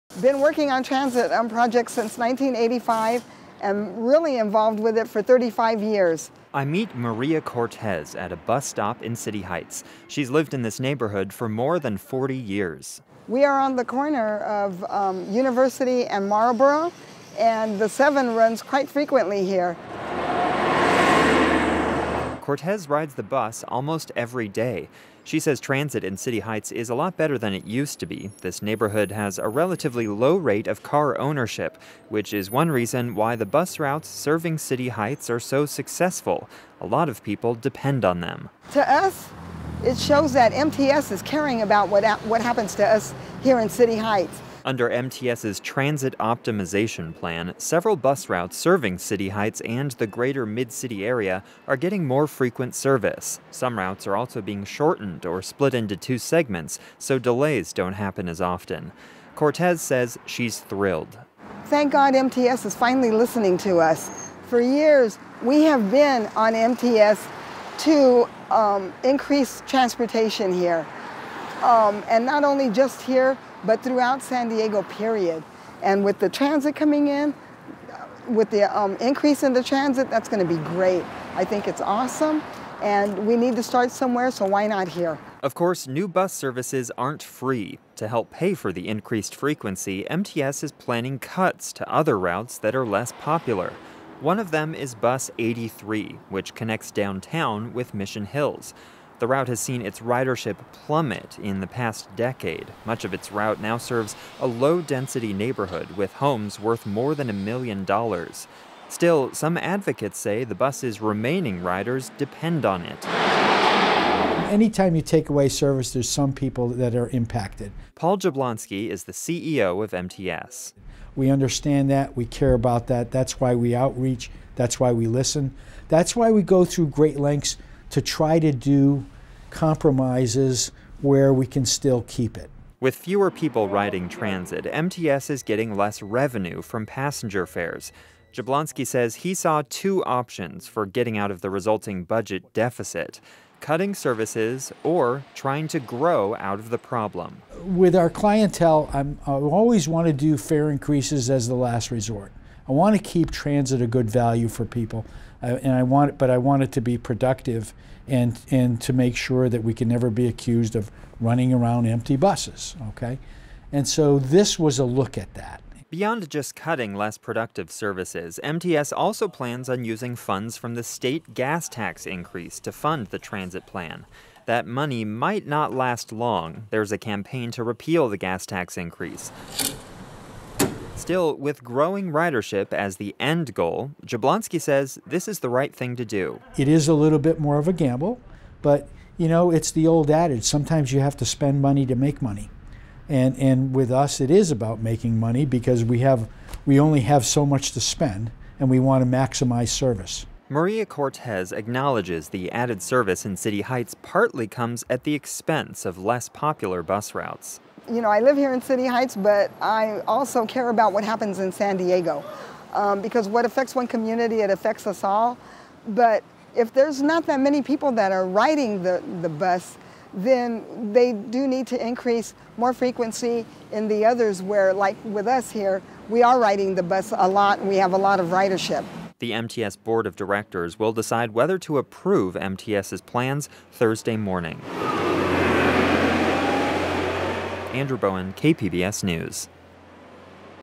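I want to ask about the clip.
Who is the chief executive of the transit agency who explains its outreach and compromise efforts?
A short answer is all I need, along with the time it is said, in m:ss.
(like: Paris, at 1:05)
Paul Jablonski, at 1:57.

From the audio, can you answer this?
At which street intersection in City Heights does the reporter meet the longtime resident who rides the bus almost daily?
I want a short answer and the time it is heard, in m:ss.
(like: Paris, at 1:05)
University and Marlborough, at 0:15.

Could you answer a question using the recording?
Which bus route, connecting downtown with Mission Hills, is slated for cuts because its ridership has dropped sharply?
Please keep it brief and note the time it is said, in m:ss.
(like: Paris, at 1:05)
Bus 83, at 1:34.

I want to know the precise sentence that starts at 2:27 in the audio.
With our clientele, I'm, I always want to do fare increases as the last resort.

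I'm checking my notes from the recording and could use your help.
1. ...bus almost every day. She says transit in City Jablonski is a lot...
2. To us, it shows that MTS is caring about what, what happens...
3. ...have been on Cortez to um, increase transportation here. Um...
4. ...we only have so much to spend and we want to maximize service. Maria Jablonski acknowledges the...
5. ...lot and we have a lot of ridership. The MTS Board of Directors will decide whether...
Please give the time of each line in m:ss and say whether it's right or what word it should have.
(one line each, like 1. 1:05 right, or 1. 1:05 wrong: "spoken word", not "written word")
1. 0:23 wrong: "Heights", not "Jablonski"
2. 0:38 right
3. 1:05 wrong: "MTS", not "Cortez"
4. 3:16 wrong: "Cortez", not "Jablonski"
5. 3:47 right.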